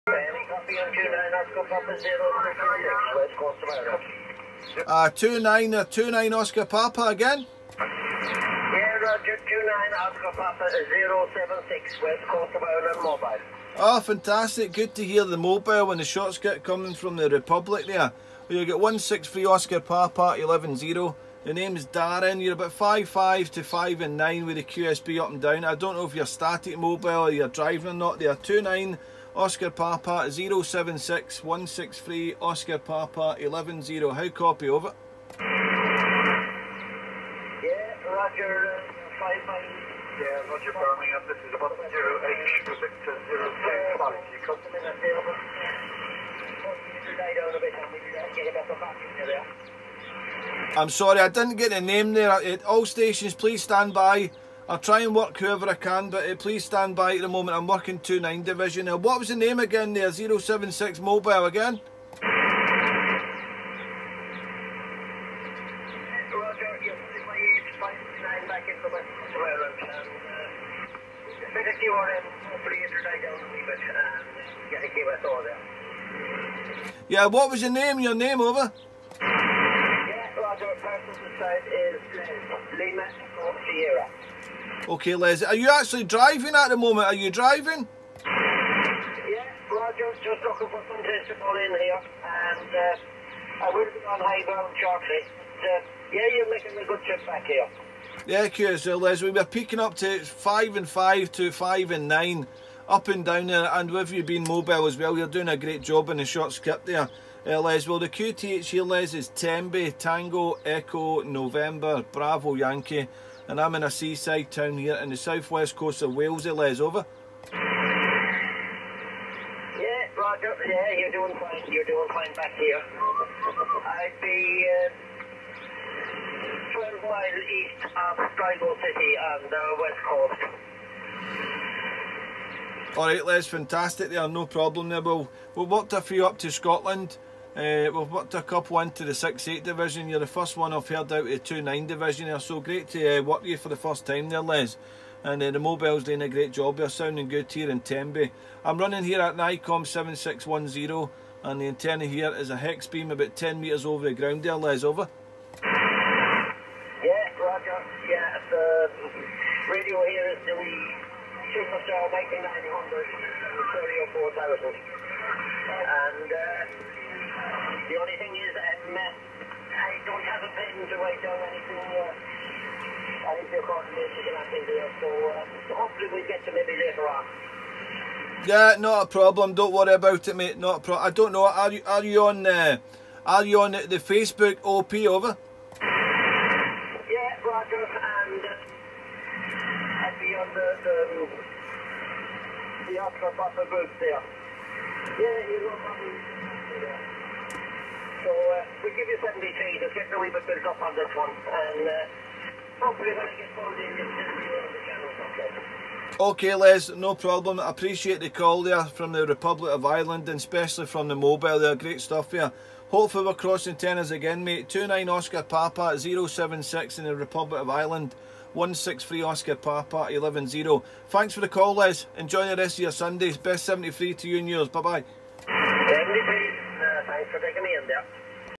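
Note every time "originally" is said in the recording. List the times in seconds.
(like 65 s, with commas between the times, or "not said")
not said.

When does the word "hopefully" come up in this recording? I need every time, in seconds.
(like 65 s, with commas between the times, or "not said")
175 s, 202 s, 212 s.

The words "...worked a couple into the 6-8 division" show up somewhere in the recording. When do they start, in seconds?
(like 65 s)
138 s.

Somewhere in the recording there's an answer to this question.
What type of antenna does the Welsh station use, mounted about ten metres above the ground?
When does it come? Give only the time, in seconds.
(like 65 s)
152 s.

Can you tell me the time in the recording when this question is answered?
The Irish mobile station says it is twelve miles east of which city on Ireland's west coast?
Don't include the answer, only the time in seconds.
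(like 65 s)
128 s.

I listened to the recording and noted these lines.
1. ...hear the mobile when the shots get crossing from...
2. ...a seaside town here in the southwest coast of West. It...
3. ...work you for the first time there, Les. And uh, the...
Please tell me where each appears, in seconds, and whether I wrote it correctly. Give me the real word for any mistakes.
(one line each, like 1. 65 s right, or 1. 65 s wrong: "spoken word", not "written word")
1. 15 s wrong: "coming", not "crossing"
2. 113 s wrong: "Wales", not "West"
3. 143 s right.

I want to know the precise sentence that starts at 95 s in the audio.
Uh, yeah, you're making a good trip back here.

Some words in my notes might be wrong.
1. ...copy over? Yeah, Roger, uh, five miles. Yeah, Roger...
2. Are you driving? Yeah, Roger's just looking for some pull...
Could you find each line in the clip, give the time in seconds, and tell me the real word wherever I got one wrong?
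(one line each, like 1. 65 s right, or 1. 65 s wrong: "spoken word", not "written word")
1. 34 s right
2. 87 s right.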